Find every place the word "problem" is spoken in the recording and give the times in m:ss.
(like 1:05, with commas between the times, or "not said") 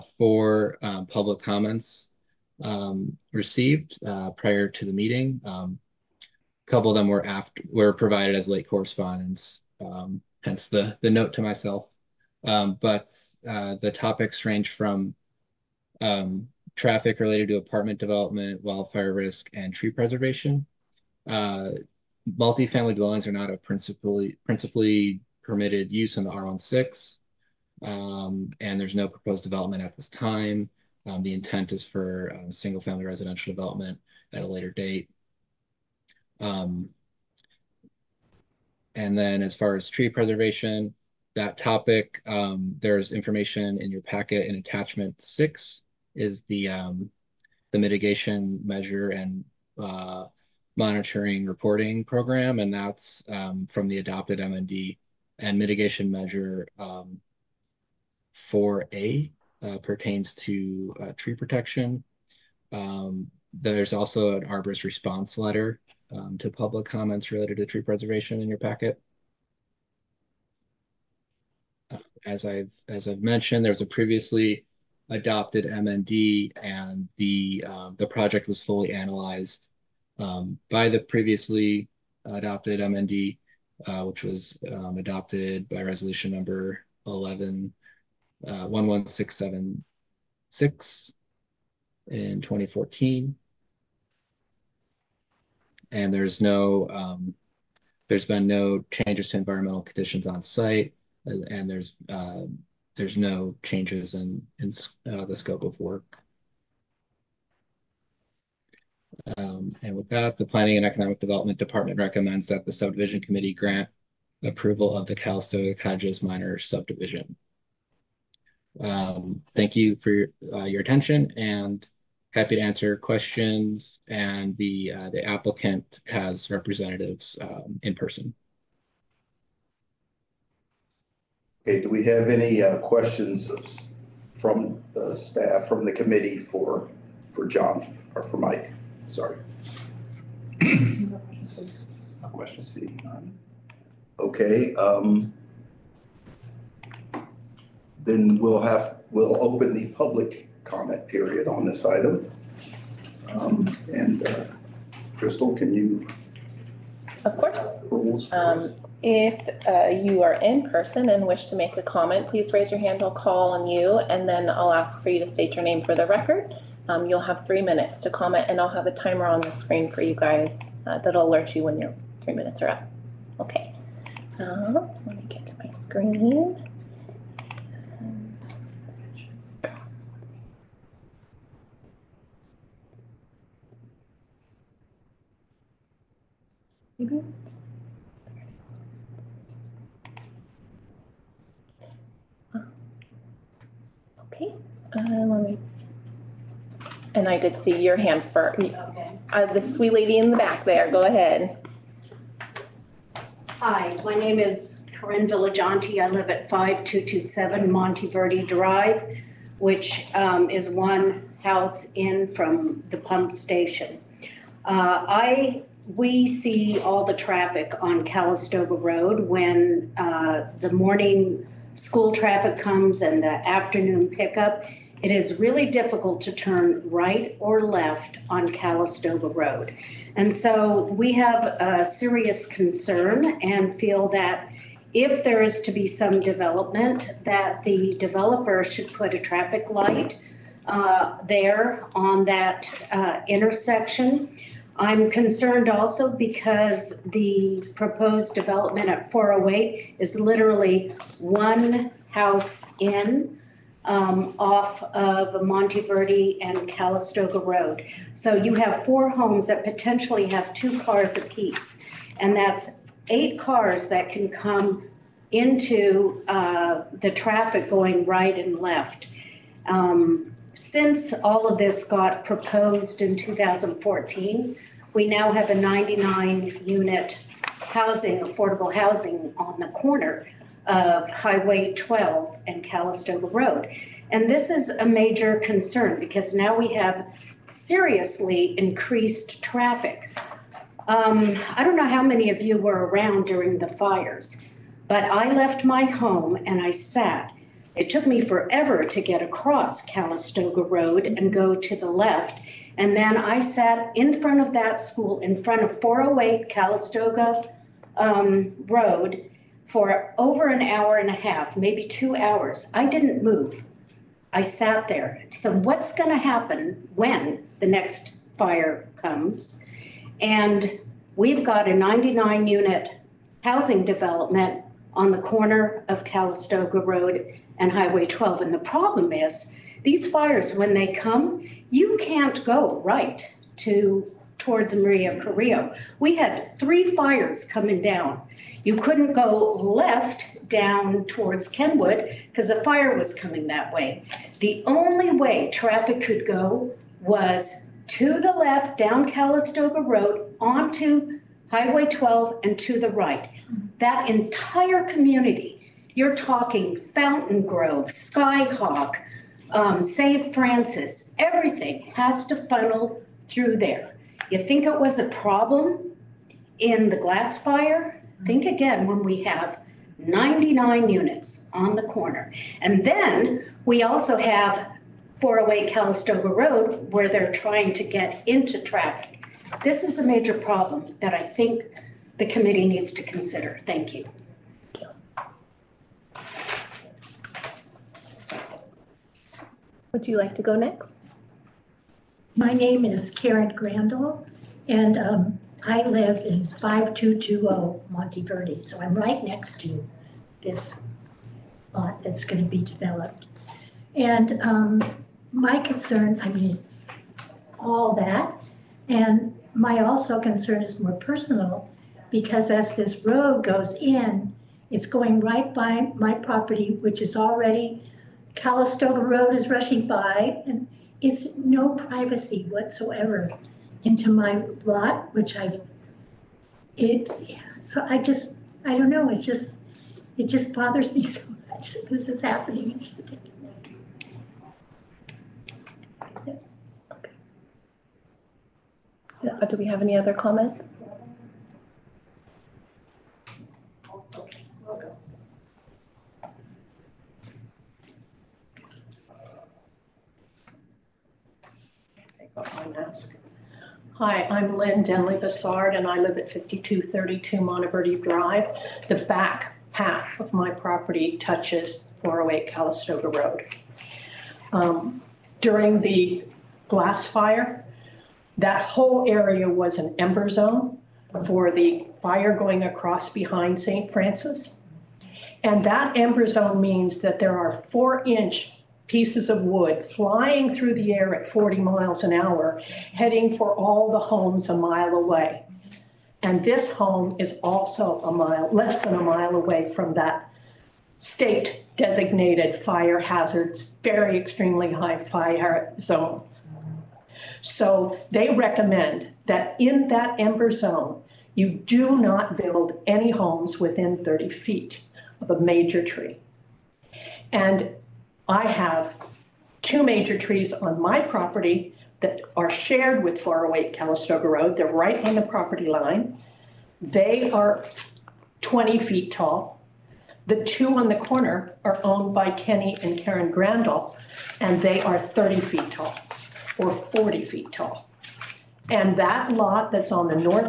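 5:28, 6:05, 6:20.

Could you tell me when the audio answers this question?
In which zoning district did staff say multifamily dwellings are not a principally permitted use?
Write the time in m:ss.
0:26.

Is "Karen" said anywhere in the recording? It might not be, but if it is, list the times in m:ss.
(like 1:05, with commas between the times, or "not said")
6:33, 8:42.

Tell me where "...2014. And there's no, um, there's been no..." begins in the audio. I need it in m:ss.
1:32.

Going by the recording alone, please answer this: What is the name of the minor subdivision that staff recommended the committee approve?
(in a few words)
Calistoga Cottages.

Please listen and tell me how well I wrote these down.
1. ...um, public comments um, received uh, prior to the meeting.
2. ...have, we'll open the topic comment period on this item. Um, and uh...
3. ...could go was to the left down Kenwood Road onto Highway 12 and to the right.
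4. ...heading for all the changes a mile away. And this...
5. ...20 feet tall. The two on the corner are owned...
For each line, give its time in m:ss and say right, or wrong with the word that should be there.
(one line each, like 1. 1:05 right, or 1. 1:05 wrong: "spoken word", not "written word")
1. 0:00 right
2. 2:28 wrong: "public", not "topic"
3. 5:46 wrong: "Calistoga", not "Kenwood"
4. 8:02 wrong: "homes", not "changes"
5. 8:38 right.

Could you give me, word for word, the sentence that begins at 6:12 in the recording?
And then we also have 408 Calistoga Road where they're trying to get into traffic.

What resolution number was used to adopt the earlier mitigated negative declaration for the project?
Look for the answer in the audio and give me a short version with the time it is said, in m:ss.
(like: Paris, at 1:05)
11676, at 1:28.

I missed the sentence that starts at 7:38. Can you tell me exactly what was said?
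The back half of my property touches 408 Calistoga Road.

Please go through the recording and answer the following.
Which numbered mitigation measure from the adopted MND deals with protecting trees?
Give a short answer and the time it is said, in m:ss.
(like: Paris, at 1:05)
4A, at 0:58.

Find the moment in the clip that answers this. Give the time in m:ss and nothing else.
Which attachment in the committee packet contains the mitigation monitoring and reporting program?
0:44.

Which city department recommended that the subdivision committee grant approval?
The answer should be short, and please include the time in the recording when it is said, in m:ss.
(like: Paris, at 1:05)
Planning and Economic Development Department, at 1:50.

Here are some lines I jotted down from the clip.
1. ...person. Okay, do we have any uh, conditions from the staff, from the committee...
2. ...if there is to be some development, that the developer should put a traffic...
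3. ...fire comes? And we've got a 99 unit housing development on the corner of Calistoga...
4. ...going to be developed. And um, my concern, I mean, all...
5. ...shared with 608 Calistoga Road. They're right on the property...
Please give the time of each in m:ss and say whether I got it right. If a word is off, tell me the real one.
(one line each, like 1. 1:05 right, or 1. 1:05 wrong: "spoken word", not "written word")
1. 2:07 wrong: "questions", not "conditions"
2. 3:54 right
3. 5:18 right
4. 6:42 right
5. 8:32 wrong: "408", not "608".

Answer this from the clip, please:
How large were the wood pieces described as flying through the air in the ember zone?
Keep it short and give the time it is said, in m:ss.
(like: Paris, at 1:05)
4 inches, at 7:57.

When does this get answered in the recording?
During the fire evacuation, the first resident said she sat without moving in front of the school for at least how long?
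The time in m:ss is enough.
5:10.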